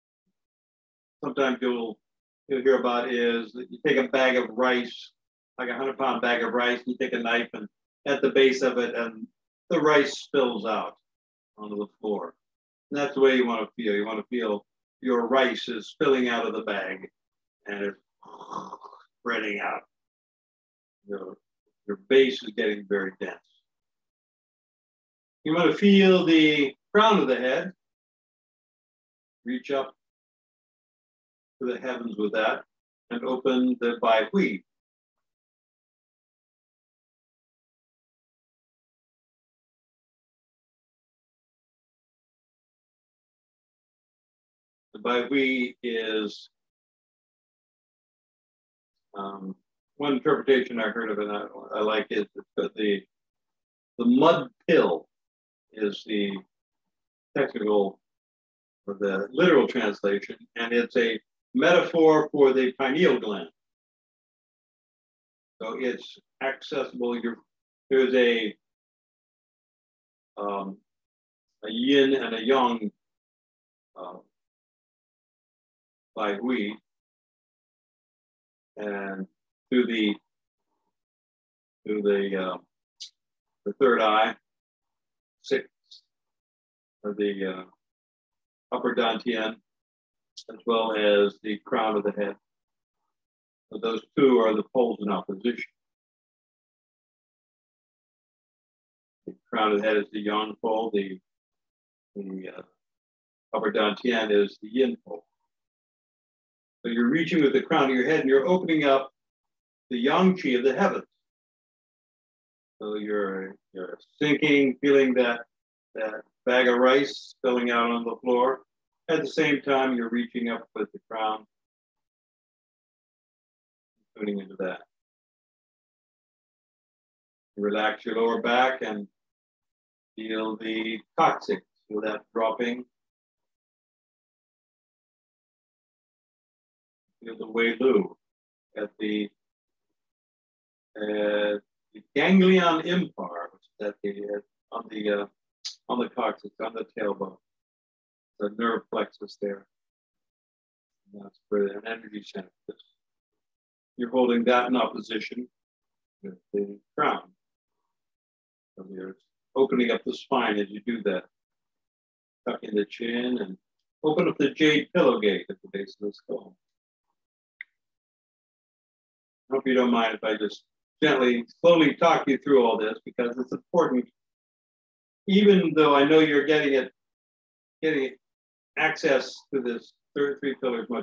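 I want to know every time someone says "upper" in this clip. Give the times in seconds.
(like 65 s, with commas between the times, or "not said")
88 s, 103 s.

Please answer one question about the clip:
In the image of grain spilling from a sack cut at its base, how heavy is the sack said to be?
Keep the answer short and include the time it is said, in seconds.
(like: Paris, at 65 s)
100 pounds, at 5 s.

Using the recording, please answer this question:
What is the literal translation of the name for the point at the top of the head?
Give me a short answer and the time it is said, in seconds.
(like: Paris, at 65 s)
mud pill, at 53 s.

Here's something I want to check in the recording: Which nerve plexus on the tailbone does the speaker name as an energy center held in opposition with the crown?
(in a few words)
ganglion impar.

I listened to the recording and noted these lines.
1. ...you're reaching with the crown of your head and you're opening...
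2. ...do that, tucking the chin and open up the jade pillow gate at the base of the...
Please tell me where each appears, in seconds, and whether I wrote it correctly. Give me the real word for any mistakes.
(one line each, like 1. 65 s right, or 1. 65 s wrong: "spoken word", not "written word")
1. 106 s right
2. 160 s right.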